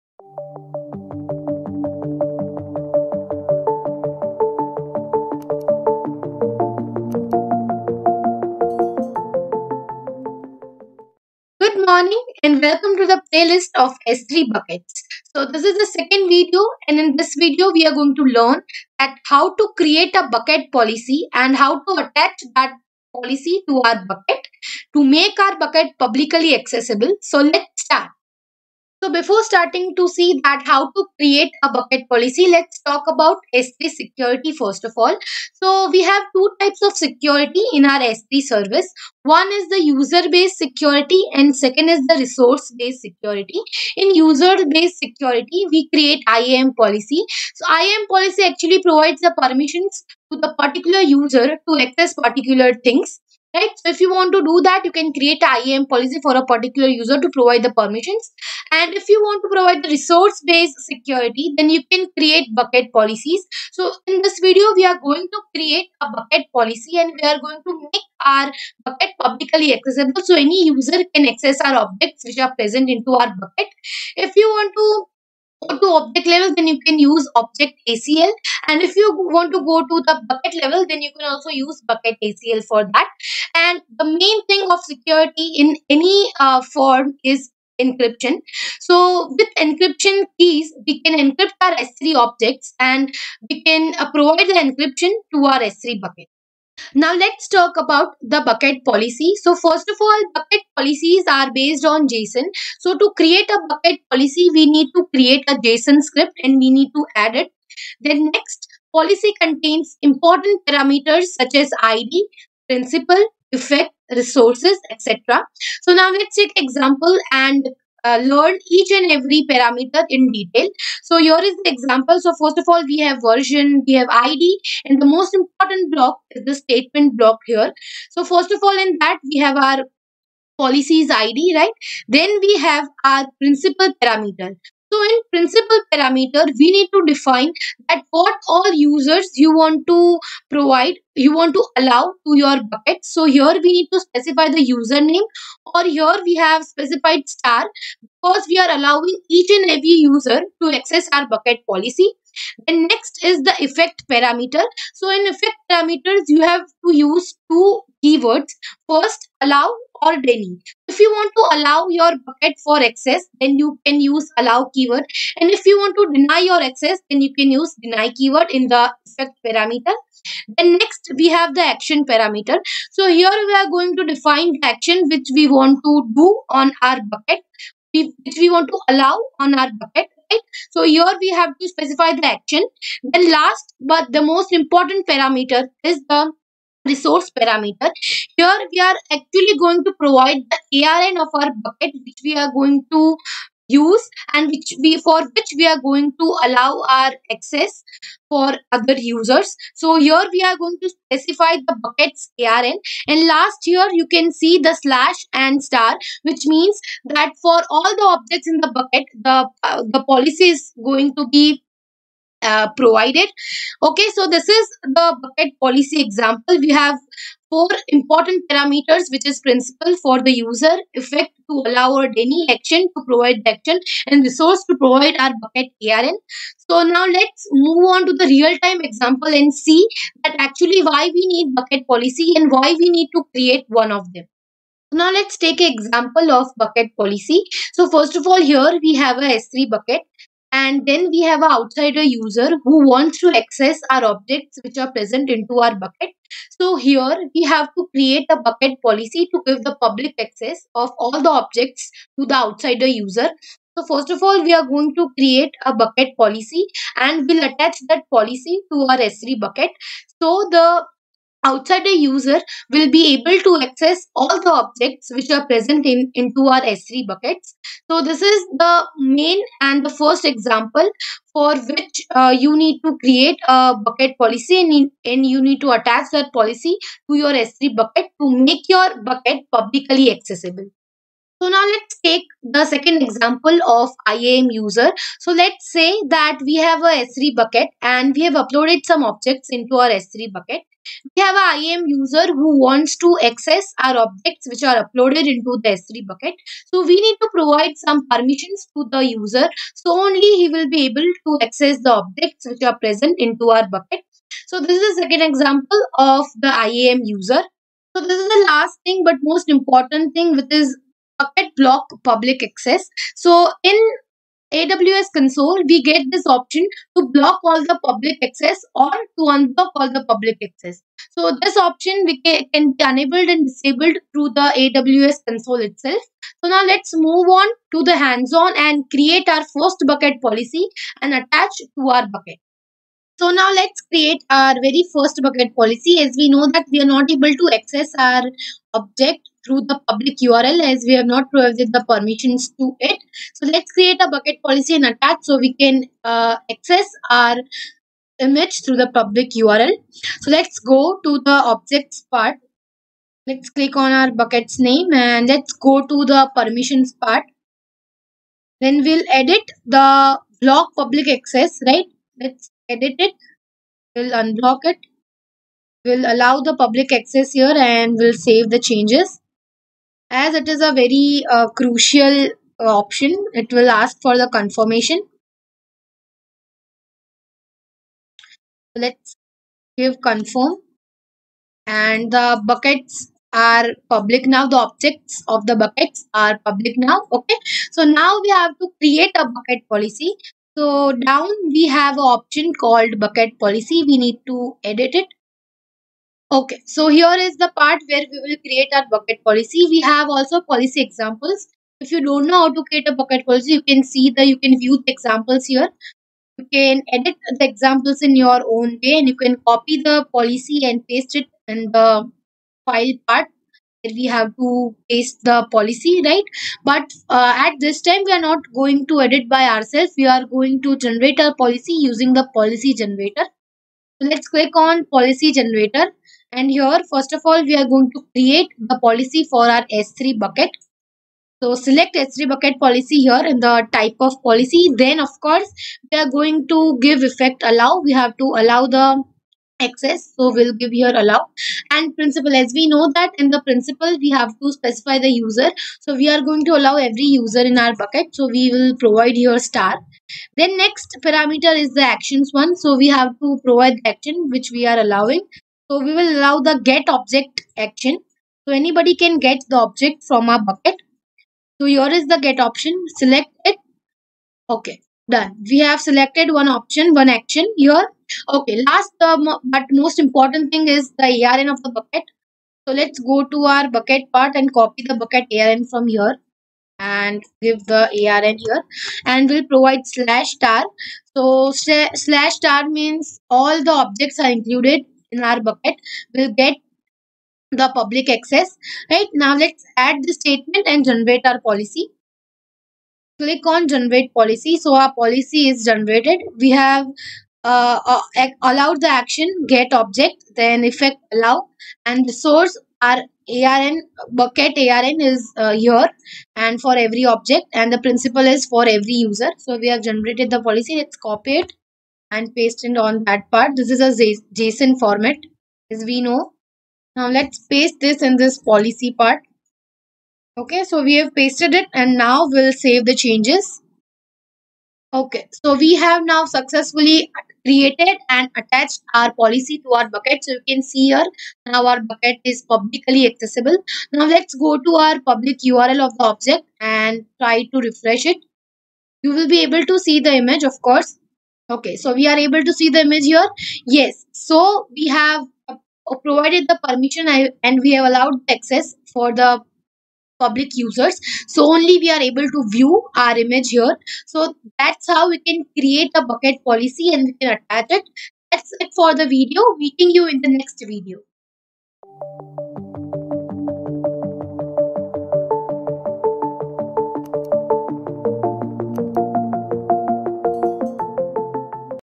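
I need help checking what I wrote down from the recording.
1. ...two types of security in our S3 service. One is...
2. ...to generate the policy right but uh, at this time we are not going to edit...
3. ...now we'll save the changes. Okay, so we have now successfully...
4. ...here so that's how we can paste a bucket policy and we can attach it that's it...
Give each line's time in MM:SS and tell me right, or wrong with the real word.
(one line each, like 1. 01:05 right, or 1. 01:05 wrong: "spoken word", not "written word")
1. 00:36 right
2. 06:54 wrong: "paste", not "generate"
3. 08:41 right
4. 09:13 wrong: "create", not "paste".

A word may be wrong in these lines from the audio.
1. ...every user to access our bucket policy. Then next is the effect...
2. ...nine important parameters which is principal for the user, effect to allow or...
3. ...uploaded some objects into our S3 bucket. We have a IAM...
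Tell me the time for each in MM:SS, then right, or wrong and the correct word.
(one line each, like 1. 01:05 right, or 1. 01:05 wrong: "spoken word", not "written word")
1. 02:29 right
2. 03:37 wrong: "four", not "nine"
3. 04:48 right.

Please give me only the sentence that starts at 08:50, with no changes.
So you can see here now our bucket is publicly accessible.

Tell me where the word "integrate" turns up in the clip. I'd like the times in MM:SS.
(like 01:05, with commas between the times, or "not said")
not said.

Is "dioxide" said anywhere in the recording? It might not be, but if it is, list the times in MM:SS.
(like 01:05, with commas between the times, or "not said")
not said.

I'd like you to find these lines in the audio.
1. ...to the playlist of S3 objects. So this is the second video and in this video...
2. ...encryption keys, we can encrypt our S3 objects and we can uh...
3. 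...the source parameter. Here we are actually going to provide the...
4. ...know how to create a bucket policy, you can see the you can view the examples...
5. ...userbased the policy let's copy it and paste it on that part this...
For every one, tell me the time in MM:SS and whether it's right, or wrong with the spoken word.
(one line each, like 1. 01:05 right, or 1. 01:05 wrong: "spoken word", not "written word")
1. 00:12 wrong: "buckets", not "objects"
2. 01:29 right
3. 03:06 wrong: "resource", not "source"
4. 06:42 right
5. 08:29 wrong: "generated", not "userbased".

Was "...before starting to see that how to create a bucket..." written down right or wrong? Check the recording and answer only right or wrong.
right.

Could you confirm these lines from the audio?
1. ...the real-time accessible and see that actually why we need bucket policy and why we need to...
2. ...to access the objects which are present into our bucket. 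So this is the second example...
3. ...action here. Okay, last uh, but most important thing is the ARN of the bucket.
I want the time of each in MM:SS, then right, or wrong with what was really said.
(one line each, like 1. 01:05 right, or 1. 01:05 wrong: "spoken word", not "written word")
1. 03:48 wrong: "example", not "accessible"
2. 05:01 right
3. 07:47 right.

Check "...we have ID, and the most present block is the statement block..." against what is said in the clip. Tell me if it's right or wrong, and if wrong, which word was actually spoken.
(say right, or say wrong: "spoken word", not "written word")
wrong: "important", not "present".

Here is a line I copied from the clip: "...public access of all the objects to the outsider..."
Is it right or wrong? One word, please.
right.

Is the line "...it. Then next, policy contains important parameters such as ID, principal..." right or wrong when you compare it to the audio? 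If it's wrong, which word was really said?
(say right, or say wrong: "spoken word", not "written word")
right.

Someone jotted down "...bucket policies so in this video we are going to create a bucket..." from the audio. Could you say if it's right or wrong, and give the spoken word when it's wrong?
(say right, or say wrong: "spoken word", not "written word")
right.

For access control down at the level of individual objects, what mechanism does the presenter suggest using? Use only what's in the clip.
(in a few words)
object ACL.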